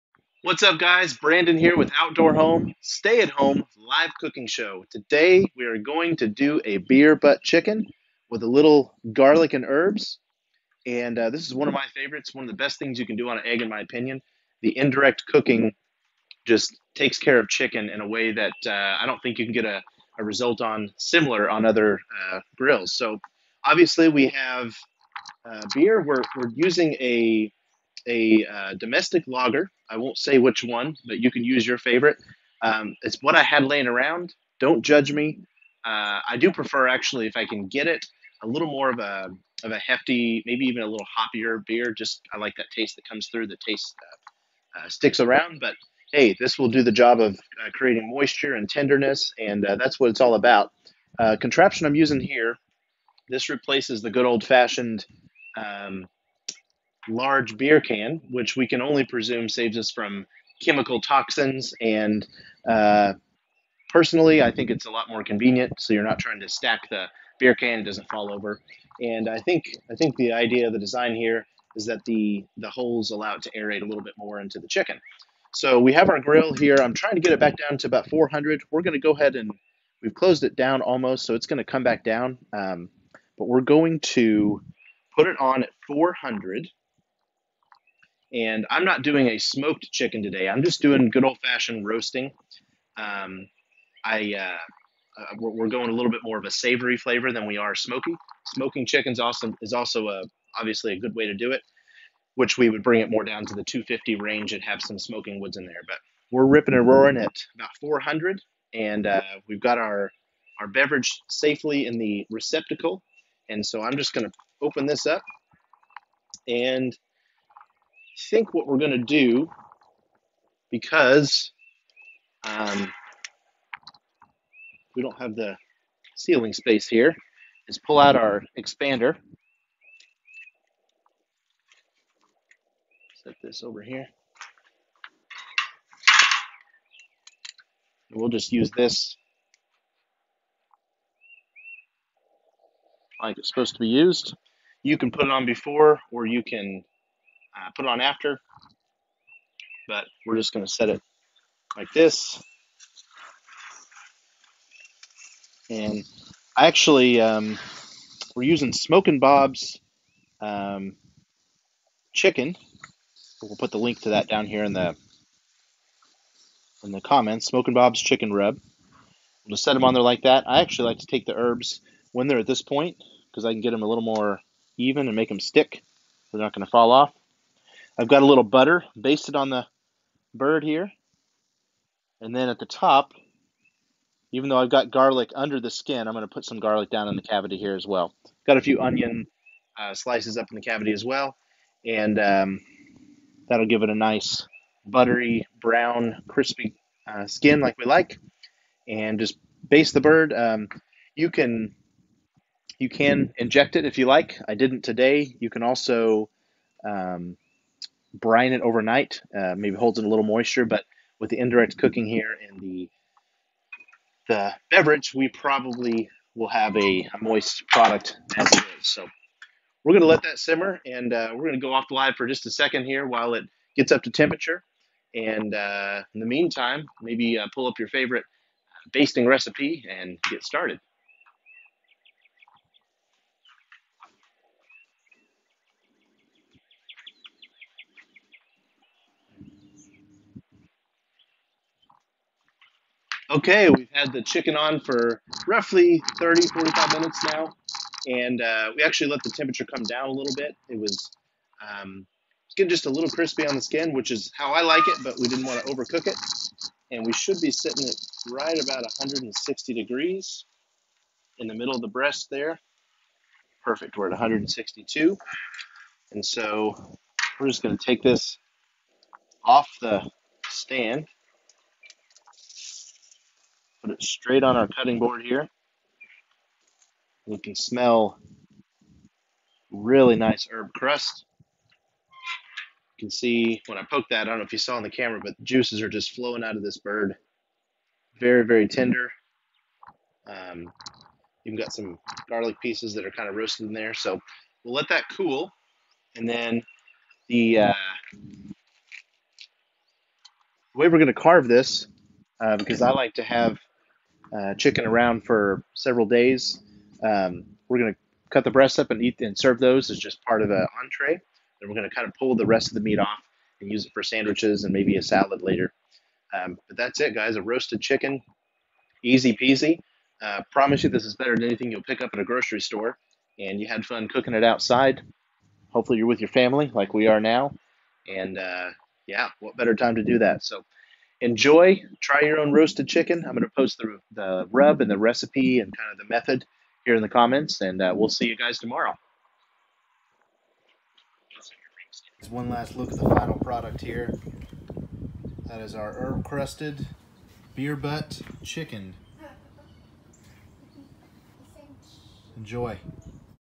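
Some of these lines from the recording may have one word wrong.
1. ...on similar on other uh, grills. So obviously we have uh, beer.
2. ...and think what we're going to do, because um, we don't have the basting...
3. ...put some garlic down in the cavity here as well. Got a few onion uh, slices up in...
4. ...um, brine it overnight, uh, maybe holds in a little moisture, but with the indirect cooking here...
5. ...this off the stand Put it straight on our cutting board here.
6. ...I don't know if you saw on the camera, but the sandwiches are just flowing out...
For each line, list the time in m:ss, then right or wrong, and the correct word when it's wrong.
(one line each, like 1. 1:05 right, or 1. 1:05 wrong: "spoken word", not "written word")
1. 0:20 right
2. 1:56 wrong: "ceiling", not "basting"
3. 3:06 right
4. 3:26 right
5. 4:28 right
6. 4:44 wrong: "juices", not "sandwiches".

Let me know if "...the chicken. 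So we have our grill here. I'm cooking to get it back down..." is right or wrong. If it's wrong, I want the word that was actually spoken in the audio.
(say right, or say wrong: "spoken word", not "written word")
wrong: "trying", not "cooking".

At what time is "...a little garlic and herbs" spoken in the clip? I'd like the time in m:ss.
0:08.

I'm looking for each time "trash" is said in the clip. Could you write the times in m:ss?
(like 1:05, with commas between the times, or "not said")
not said.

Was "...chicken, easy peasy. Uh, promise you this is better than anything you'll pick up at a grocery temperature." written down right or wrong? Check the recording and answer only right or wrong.
wrong.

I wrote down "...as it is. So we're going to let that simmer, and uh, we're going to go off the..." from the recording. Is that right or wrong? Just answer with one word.
right.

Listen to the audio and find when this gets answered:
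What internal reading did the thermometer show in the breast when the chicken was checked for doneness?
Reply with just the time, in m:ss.
4:24.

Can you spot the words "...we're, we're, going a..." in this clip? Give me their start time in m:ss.
1:35.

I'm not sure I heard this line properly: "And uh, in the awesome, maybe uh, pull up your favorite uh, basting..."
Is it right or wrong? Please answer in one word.
wrong.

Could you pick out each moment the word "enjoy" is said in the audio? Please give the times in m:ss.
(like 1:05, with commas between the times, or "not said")
5:31, 5:52.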